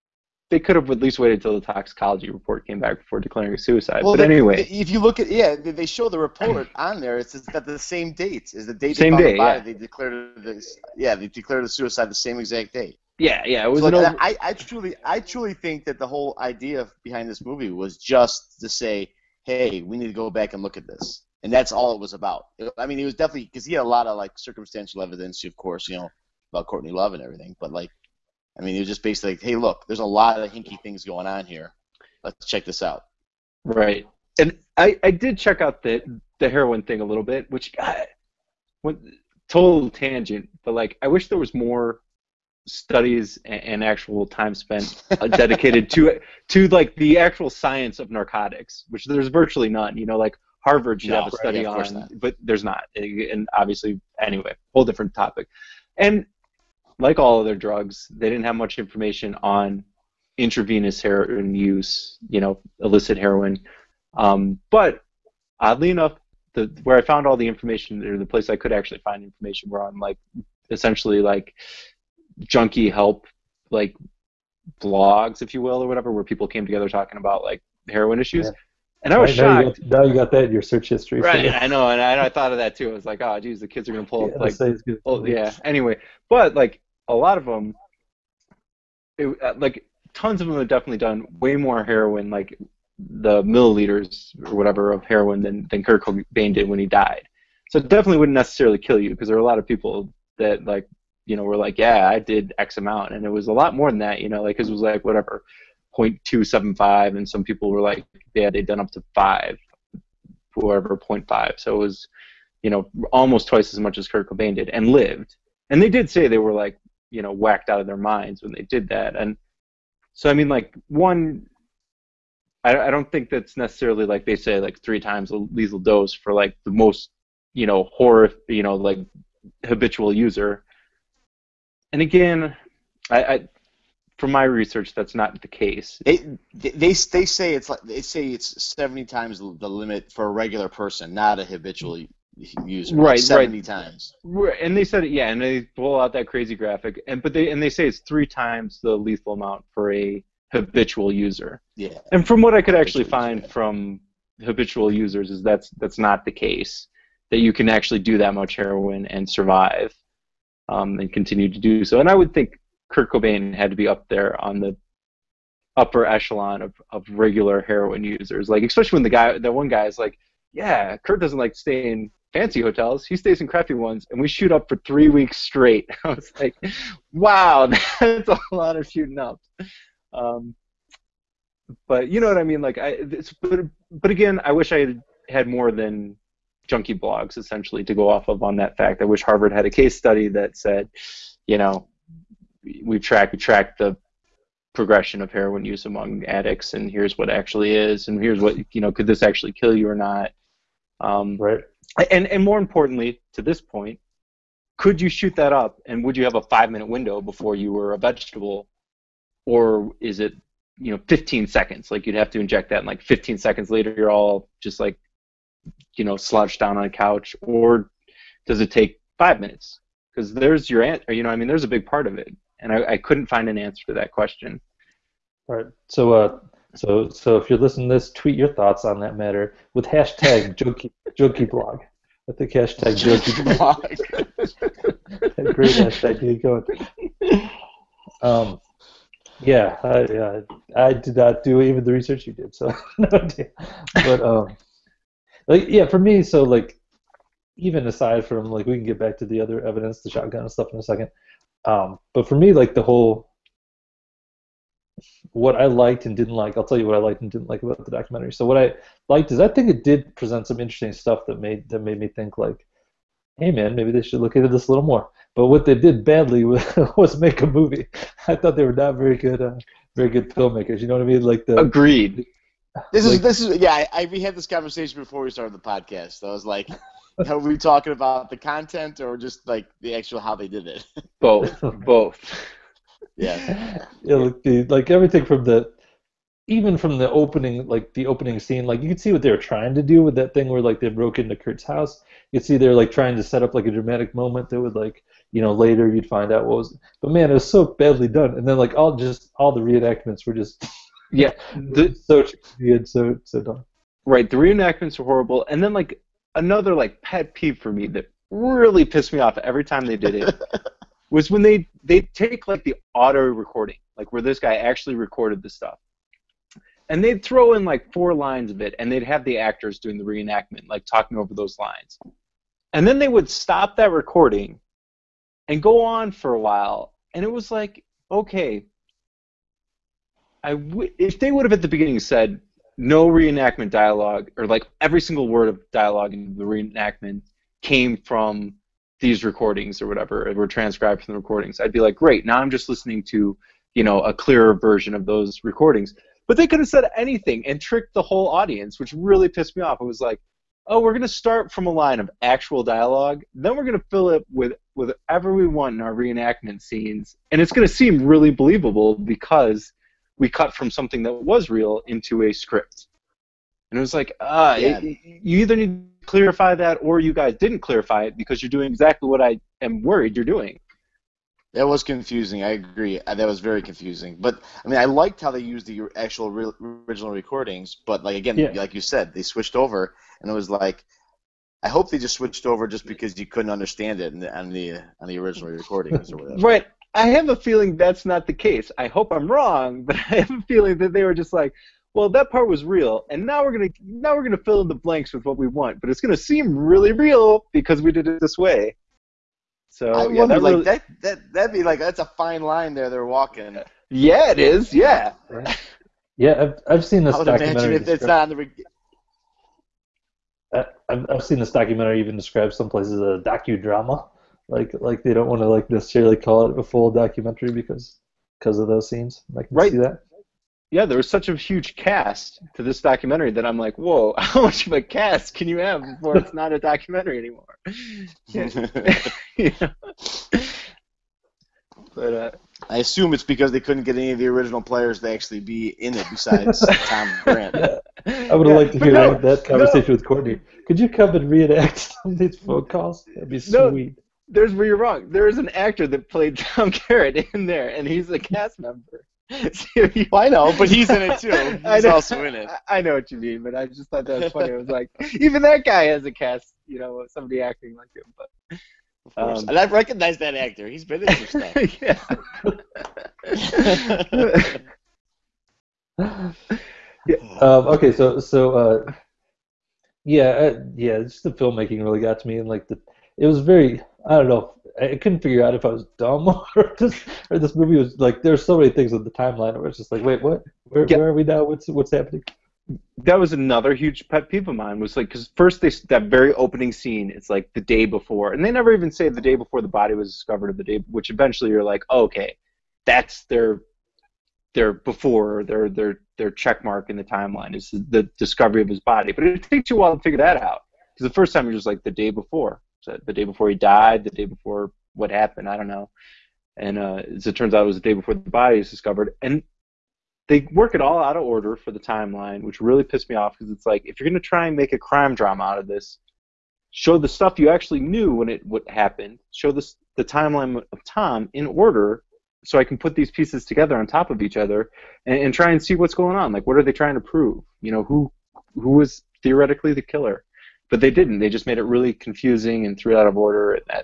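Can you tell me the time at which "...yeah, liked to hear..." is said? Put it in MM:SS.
07:18.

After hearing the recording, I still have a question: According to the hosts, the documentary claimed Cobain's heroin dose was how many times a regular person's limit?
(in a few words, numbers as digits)
70.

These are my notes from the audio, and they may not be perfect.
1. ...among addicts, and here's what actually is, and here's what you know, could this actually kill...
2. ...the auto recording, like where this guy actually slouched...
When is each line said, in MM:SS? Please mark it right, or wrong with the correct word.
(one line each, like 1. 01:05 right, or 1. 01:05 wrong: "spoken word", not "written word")
1. 03:15 right
2. 05:12 wrong: "recorded", not "slouched".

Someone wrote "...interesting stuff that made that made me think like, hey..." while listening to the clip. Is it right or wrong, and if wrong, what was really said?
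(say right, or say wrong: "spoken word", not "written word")
right.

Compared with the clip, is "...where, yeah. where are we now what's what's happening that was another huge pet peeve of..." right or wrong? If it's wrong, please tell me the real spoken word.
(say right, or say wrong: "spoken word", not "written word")
right.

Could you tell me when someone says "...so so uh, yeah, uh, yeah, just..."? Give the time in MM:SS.
07:47.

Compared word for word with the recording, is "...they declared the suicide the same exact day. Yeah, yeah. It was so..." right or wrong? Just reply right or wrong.
right.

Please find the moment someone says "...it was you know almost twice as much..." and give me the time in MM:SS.
01:51.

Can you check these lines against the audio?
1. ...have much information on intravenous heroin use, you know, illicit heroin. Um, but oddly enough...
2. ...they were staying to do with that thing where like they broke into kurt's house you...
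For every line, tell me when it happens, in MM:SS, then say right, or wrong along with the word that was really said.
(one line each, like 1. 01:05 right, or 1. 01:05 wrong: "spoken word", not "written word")
1. 00:58 right
2. 04:49 wrong: "trying", not "staying".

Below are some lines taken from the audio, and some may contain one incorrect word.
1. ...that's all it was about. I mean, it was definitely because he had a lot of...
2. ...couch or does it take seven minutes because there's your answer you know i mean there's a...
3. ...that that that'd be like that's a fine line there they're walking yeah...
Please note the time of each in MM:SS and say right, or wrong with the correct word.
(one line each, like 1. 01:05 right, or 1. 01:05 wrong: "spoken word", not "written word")
1. 00:21 right
2. 03:36 wrong: "five", not "seven"
3. 06:40 right.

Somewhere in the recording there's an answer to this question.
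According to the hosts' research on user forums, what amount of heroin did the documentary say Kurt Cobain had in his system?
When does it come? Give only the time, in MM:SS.
01:45.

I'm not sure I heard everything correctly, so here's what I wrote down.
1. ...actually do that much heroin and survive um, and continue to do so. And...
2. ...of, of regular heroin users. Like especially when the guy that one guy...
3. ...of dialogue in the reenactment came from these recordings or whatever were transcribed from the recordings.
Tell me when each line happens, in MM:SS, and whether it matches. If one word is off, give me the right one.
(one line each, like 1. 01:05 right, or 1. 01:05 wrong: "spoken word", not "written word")
1. 02:37 right
2. 02:46 right
3. 05:35 right.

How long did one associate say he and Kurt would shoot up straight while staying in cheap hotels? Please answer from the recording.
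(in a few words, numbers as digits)
three weeks.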